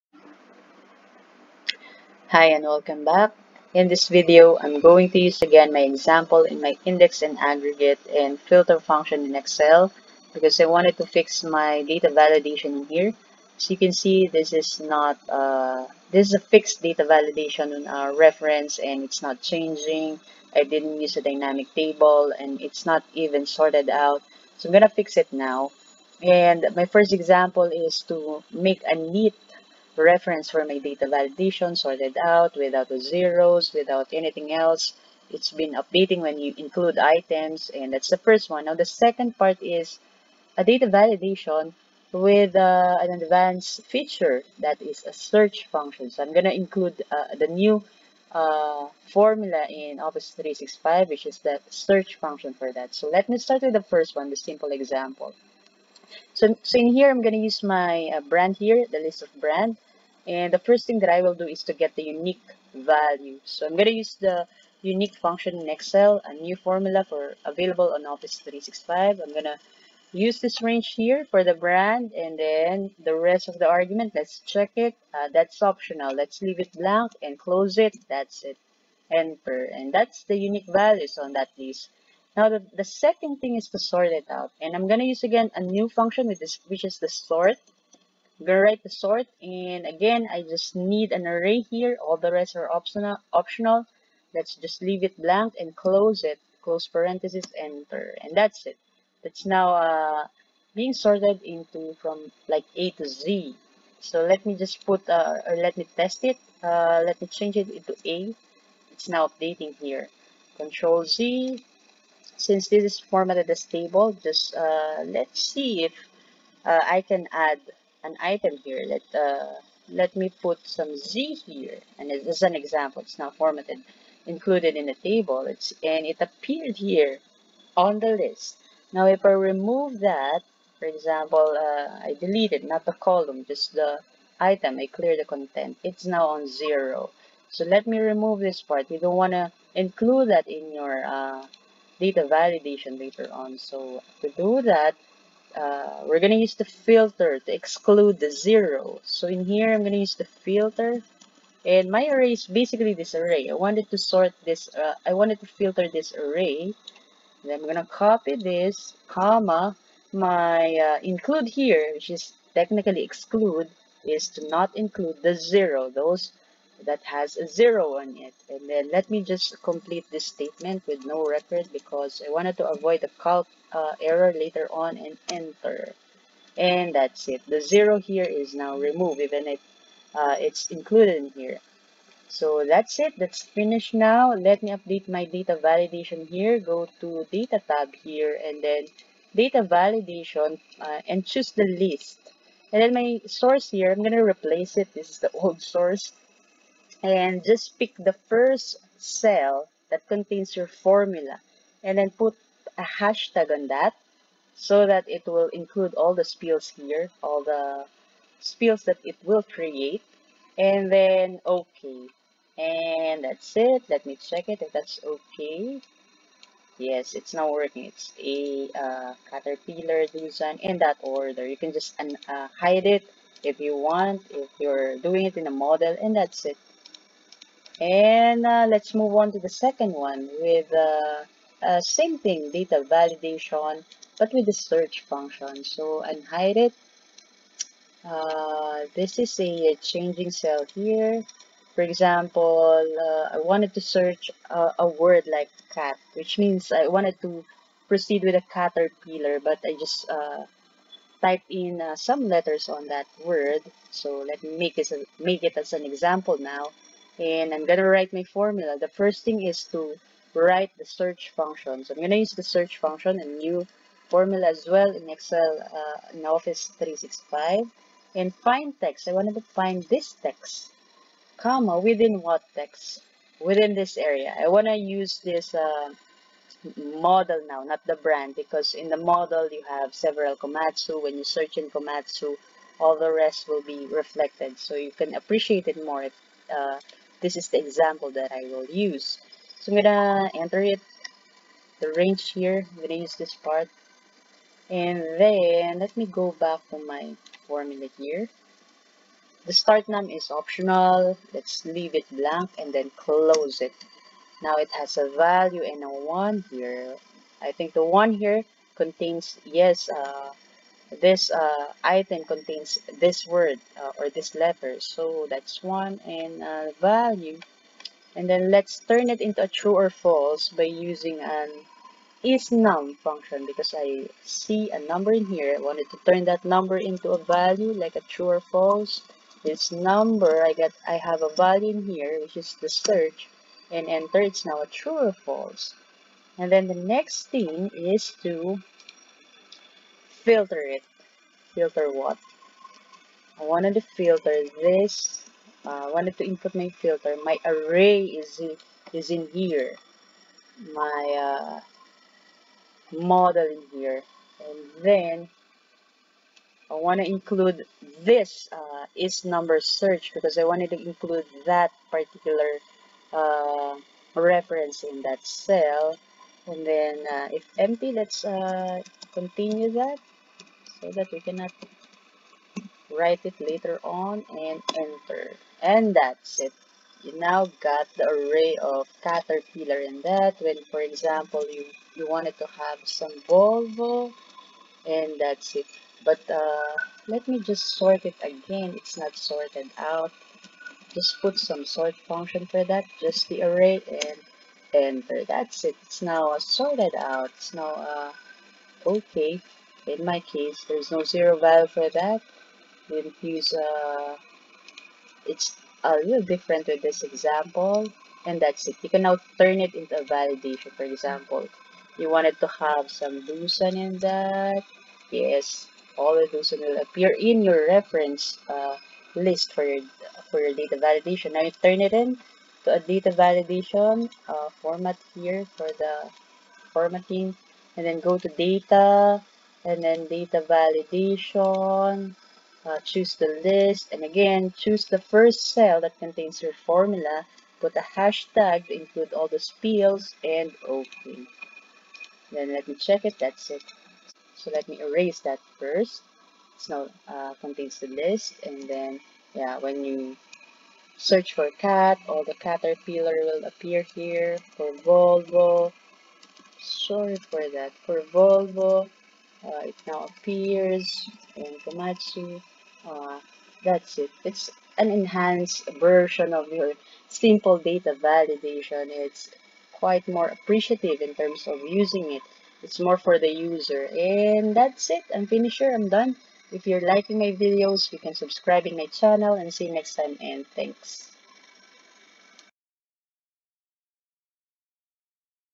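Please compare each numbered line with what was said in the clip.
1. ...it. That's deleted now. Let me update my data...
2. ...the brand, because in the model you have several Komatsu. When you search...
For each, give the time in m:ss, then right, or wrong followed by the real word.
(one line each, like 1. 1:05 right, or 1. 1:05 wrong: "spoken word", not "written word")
1. 3:02 wrong: "finished", not "deleted"
2. 4:37 right.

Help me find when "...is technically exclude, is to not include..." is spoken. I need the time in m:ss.
2:42.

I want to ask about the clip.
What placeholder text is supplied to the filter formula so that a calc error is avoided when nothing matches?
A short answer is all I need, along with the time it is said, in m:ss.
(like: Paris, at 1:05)
no record, at 2:51.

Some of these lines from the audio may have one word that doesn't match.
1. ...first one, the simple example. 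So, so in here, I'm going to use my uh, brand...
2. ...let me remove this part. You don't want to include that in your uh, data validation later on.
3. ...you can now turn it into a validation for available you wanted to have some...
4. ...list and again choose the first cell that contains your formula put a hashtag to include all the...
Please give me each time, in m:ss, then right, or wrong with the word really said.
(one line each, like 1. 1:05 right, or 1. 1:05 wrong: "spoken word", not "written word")
1. 0:53 right
2. 2:17 right
3. 6:48 wrong: "example", not "available"
4. 7:13 right.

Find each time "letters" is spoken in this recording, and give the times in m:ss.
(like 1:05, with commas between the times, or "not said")
4:12, 5:14.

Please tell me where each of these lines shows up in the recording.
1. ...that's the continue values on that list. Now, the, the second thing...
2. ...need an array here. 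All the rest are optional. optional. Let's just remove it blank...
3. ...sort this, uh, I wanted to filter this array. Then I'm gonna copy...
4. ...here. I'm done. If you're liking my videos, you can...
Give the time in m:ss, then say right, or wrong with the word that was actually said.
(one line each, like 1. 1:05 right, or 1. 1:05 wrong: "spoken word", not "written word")
1. 1:19 wrong: "unique", not "continue"
2. 1:30 wrong: "leave", not "remove"
3. 2:33 right
4. 7:55 right.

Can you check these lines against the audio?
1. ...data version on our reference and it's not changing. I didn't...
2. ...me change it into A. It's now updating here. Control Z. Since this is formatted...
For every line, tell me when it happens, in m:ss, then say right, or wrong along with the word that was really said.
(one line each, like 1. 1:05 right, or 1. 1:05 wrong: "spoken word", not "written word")
1. 0:16 wrong: "validation", not "version"
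2. 1:47 right.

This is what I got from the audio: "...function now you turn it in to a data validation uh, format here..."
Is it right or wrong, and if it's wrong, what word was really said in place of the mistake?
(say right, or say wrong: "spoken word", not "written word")
wrong: "validation", not "function".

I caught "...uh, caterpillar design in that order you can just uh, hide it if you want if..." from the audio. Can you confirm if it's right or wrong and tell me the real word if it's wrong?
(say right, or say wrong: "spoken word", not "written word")
right.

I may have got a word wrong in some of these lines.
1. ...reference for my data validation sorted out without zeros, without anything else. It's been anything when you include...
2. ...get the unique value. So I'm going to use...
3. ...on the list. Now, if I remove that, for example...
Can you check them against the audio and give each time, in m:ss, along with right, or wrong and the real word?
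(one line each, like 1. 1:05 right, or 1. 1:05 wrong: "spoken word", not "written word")
1. 0:30 wrong: "updating", not "anything"
2. 1:01 right
3. 2:07 right.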